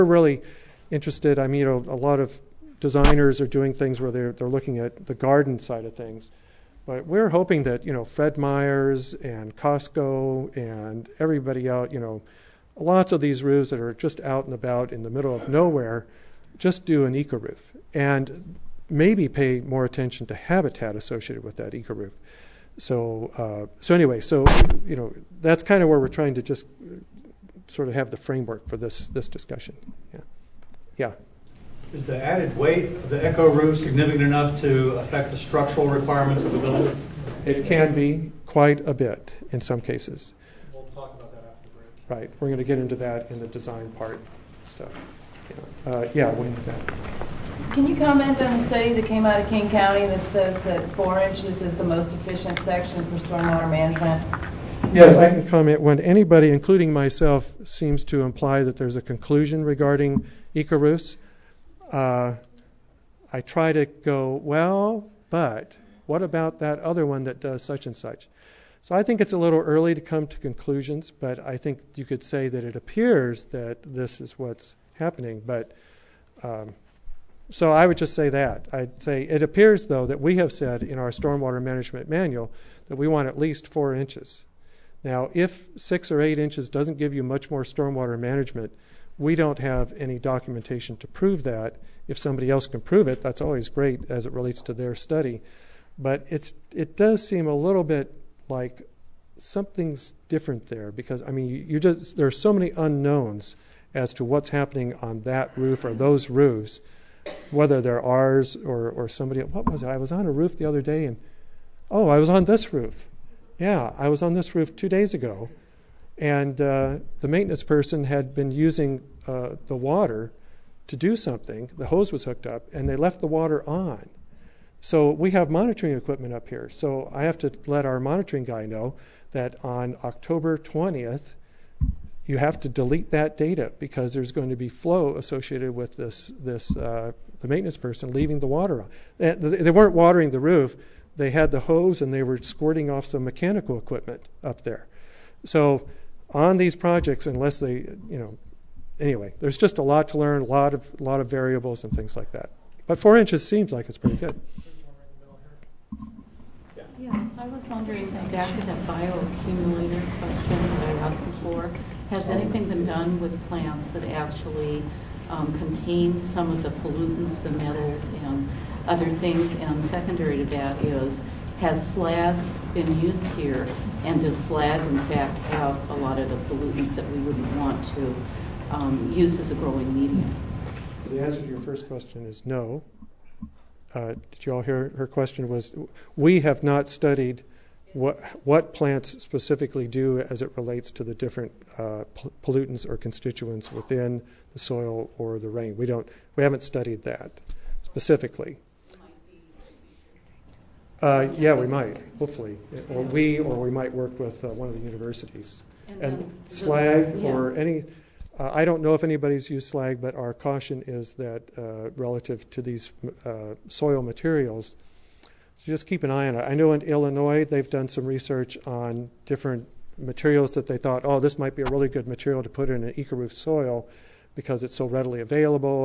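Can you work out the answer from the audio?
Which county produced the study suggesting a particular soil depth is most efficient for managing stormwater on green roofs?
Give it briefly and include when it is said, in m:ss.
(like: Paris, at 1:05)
King County, at 0:49.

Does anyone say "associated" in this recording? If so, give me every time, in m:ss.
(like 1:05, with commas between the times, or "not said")
0:20, 2:15.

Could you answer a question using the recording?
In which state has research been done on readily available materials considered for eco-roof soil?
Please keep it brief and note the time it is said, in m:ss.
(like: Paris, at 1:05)
Illinois, at 3:36.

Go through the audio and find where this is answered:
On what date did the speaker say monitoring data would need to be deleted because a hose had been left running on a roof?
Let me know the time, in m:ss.
2:10.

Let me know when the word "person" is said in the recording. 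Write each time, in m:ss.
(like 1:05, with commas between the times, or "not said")
1:57, 2:17.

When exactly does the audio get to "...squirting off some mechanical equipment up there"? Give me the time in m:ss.
2:22.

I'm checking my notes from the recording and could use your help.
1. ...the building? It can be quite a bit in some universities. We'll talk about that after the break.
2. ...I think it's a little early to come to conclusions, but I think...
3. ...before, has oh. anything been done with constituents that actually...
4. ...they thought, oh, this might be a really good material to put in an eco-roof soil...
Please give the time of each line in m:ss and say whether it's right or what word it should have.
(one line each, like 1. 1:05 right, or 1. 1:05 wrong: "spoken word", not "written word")
1. 0:36 wrong: "cases", not "universities"
2. 1:08 right
3. 2:41 wrong: "plants", not "constituents"
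4. 3:40 right.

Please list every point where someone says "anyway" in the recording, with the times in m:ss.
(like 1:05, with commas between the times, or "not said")
0:23, 2:28.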